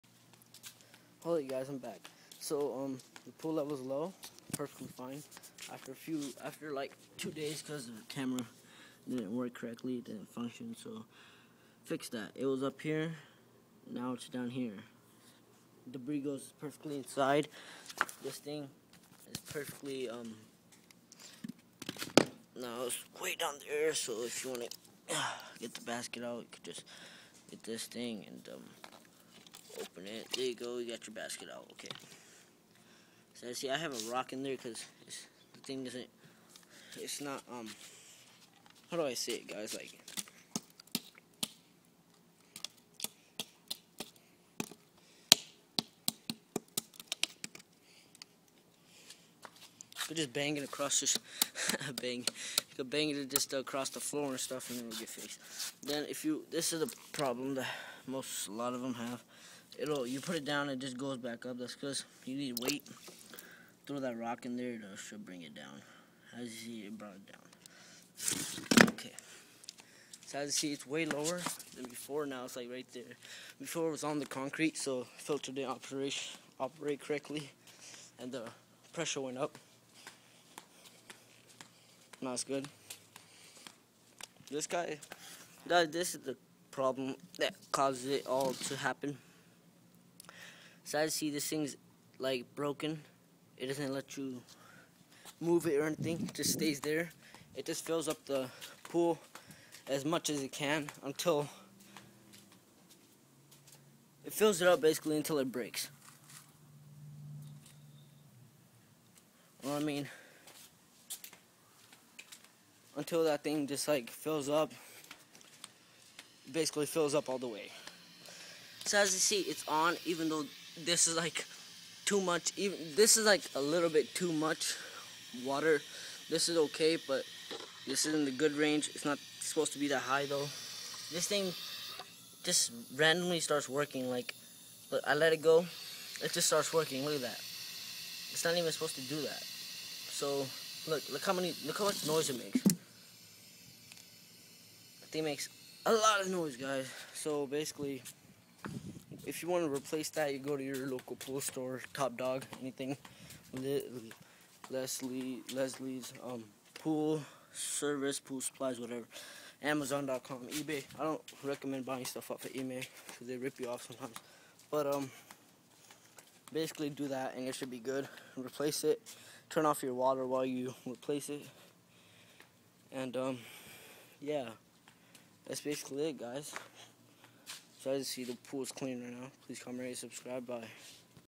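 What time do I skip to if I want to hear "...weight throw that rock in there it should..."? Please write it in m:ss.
1:02.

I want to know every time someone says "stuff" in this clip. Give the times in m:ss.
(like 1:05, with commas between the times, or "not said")
0:54, 2:42.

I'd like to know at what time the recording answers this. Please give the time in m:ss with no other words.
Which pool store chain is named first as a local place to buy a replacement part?
2:31.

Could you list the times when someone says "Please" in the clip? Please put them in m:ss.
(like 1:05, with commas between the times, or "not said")
2:59.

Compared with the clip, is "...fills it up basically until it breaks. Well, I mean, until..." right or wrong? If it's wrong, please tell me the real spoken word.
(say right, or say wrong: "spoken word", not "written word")
right.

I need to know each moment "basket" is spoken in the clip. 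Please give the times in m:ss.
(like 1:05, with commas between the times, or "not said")
0:25, 0:31.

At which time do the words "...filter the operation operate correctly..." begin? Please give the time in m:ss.
1:15.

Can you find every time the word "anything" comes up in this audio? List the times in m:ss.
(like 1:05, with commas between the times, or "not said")
1:35, 2:32.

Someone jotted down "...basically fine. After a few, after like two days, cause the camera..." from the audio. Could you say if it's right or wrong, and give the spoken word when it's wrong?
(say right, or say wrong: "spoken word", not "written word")
wrong: "perfectly", not "basically".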